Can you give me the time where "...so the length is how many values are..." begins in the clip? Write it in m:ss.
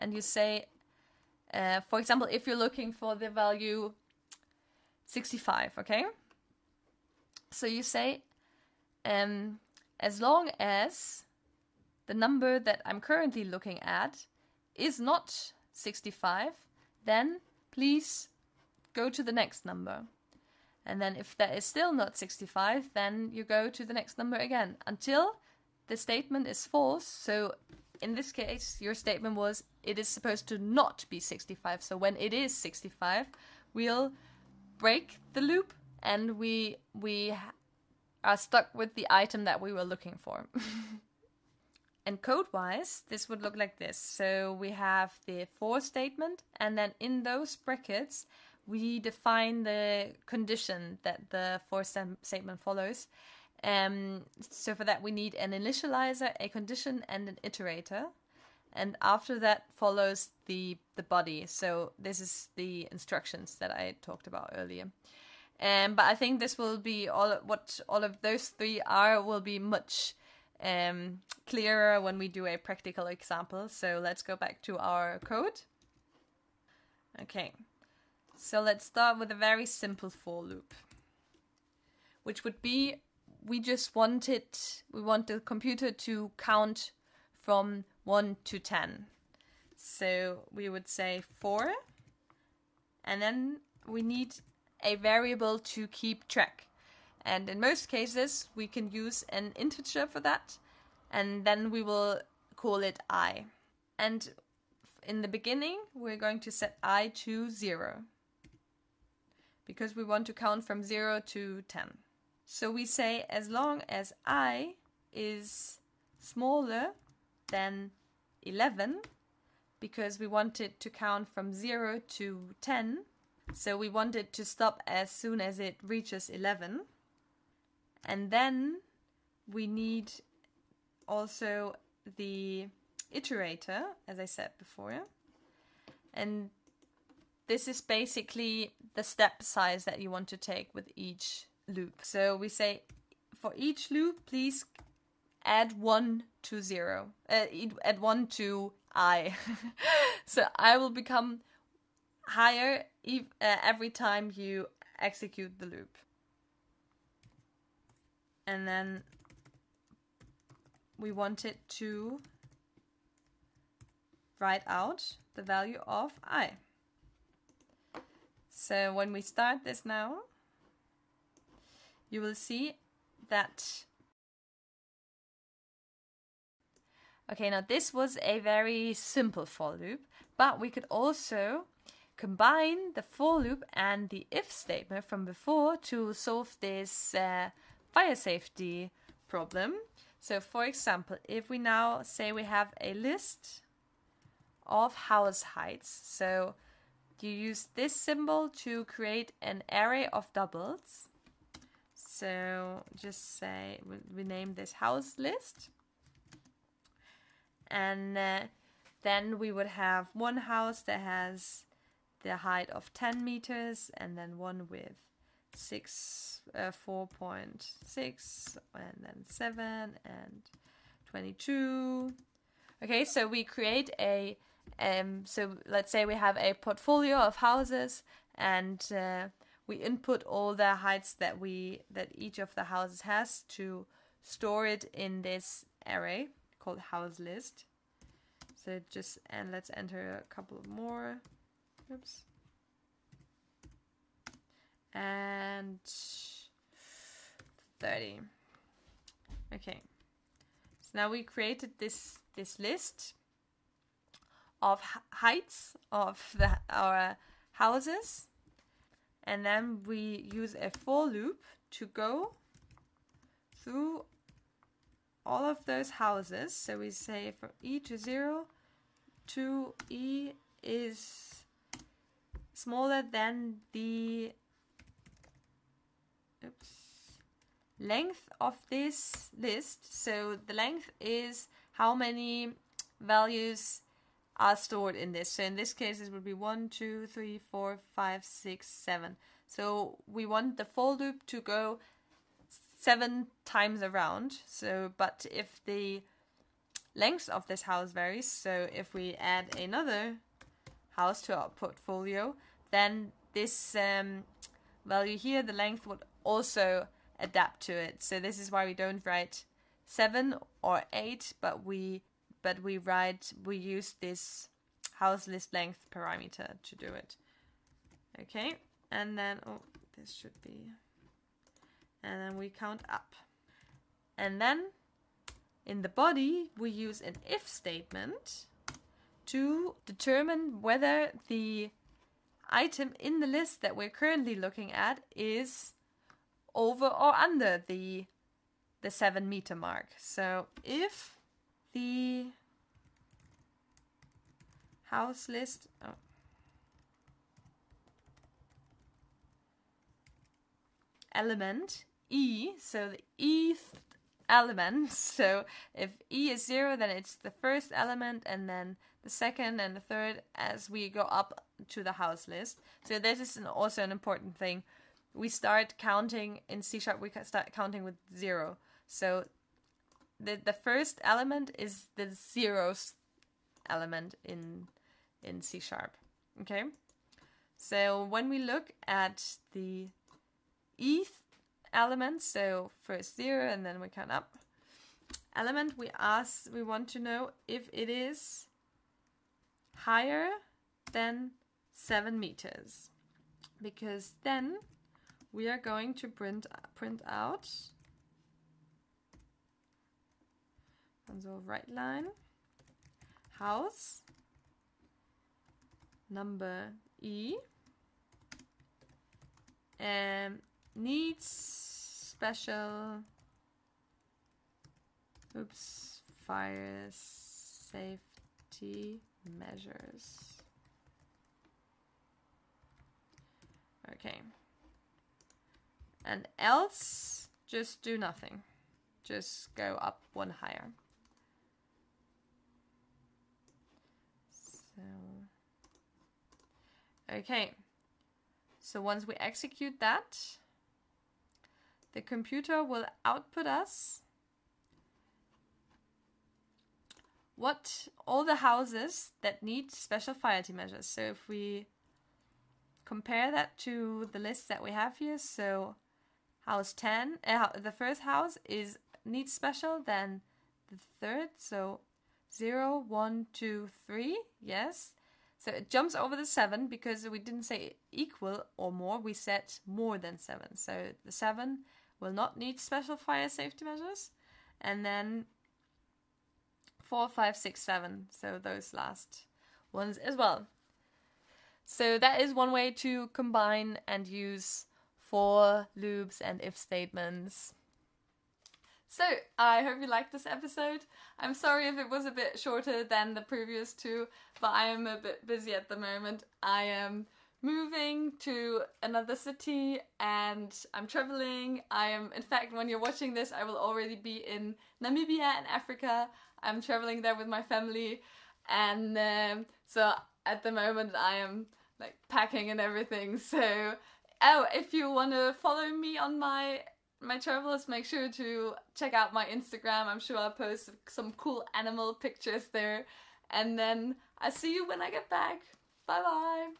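4:40.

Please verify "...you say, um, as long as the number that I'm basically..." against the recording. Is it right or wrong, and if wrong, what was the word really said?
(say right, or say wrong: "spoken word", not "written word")
wrong: "currently", not "basically".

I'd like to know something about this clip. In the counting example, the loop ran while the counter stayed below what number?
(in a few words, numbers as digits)
11.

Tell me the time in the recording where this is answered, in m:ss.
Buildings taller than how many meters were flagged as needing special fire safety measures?
6:31.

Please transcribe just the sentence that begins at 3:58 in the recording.
So just and let's enter a couple more.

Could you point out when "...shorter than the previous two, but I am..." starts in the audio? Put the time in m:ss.
8:12.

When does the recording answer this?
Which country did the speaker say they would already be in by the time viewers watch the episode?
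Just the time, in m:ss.
8:24.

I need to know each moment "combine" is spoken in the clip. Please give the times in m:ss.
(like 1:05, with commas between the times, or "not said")
3:02, 8:03.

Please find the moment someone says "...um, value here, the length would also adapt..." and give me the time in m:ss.
5:03.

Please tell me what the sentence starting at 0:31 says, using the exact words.
So when it is 65, we'll break the loop and we we are stuck with the item that we were looking for.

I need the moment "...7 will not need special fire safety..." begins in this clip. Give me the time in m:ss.
7:51.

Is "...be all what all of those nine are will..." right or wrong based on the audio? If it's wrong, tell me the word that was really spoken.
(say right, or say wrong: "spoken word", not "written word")
wrong: "three", not "nine".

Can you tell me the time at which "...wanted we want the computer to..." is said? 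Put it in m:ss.
1:23.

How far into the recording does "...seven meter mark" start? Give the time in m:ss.
5:38.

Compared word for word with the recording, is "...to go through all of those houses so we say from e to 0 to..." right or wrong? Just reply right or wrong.
right.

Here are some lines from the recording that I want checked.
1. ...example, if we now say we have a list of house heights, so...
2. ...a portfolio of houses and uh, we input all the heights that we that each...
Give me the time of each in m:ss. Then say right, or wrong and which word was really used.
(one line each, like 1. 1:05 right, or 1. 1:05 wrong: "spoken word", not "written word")
1. 3:10 right
2. 3:46 right.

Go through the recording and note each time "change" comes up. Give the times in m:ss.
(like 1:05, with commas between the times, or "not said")
not said.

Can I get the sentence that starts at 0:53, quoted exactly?
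Um, so for that, we need an initializer, a condition, and an iterator.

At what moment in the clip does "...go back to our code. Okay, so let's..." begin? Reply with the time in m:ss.
1:14.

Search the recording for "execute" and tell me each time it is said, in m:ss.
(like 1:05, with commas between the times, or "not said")
2:35, 7:19.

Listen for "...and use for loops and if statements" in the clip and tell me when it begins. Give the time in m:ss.
8:03.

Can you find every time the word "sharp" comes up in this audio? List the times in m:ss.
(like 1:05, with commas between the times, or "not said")
6:06, 6:15.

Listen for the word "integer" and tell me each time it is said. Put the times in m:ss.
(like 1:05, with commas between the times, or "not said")
1:39.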